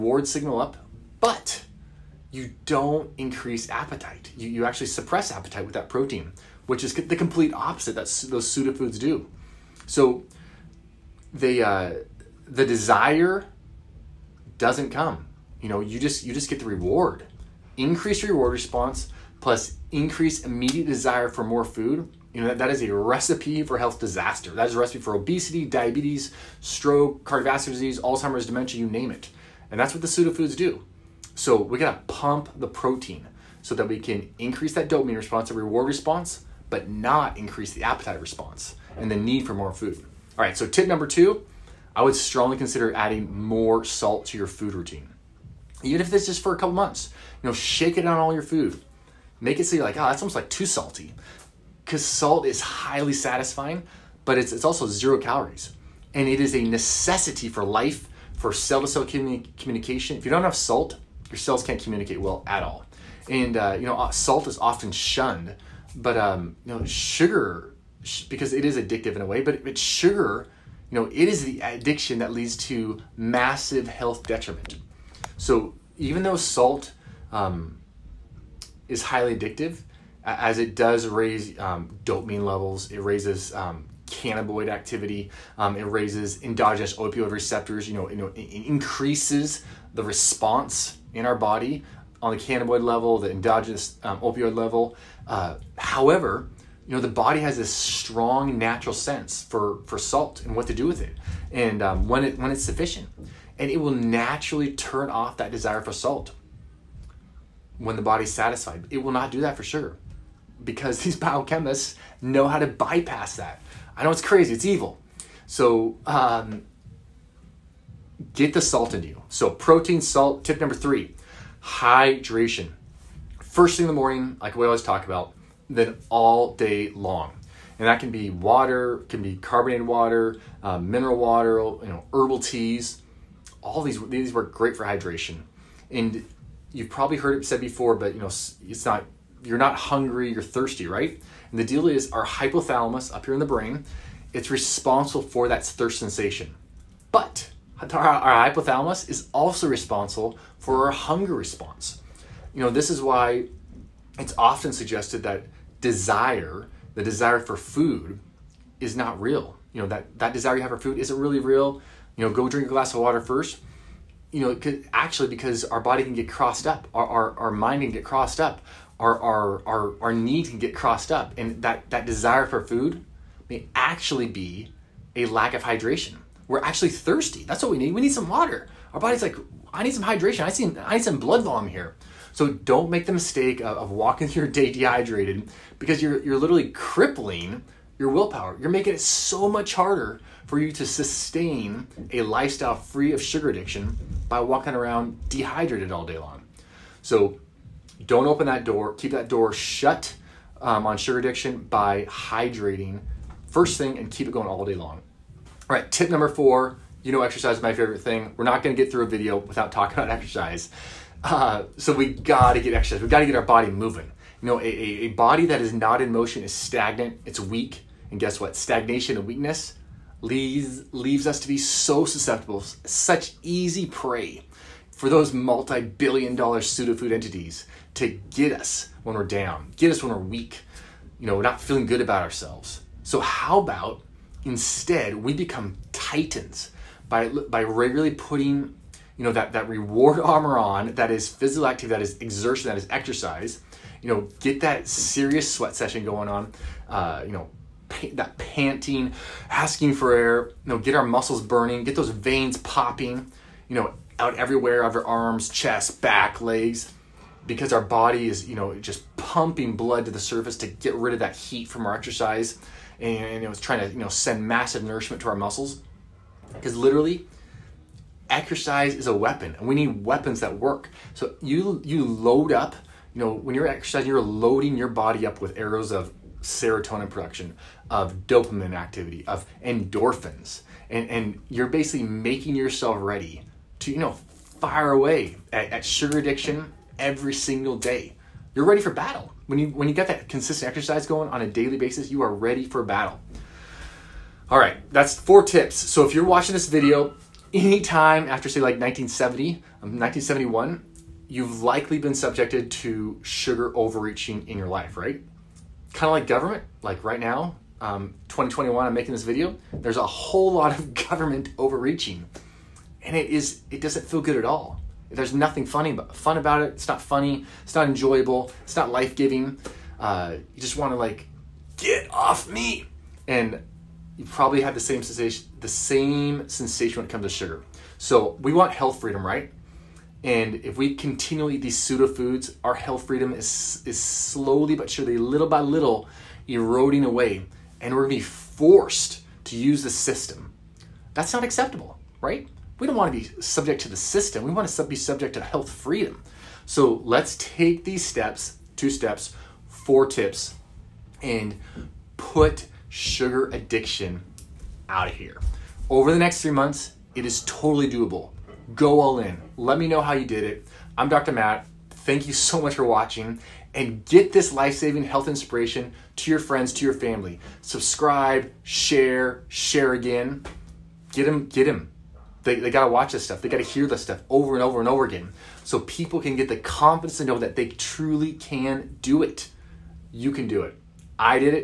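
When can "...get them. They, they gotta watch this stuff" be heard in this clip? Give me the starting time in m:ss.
6:11.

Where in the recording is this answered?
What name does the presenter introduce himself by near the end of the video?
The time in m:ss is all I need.
6:01.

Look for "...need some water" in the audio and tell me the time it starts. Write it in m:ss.
2:58.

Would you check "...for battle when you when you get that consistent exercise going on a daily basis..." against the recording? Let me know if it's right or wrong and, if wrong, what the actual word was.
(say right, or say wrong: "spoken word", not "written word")
right.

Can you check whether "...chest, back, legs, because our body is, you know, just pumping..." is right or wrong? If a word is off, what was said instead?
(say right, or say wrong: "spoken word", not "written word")
right.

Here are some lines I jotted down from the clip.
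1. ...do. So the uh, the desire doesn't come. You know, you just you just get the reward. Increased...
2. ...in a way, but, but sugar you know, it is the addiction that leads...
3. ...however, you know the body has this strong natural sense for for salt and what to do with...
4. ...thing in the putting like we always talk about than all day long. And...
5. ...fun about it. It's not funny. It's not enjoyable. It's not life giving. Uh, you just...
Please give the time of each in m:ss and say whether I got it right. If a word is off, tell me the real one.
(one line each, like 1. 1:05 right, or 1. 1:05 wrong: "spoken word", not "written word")
1. 0:08 right
2. 1:09 right
3. 1:35 right
4. 2:03 wrong: "morning", not "putting"
5. 5:16 right.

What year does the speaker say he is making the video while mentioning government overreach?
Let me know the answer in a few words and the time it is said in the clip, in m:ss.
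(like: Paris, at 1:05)
2021, at 5:08.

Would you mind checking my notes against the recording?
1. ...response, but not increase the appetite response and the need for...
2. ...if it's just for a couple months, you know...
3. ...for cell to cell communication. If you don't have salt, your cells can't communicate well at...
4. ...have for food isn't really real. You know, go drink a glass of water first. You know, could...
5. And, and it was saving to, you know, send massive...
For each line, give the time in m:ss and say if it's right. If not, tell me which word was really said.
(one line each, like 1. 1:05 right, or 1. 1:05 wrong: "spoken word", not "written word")
1. 0:35 right
2. 0:46 right
3. 0:58 right
4. 2:40 right
5. 4:23 wrong: "trying", not "saving".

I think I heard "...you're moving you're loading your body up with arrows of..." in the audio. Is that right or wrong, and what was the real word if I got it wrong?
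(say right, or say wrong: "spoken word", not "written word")
wrong: "exercising", not "moving".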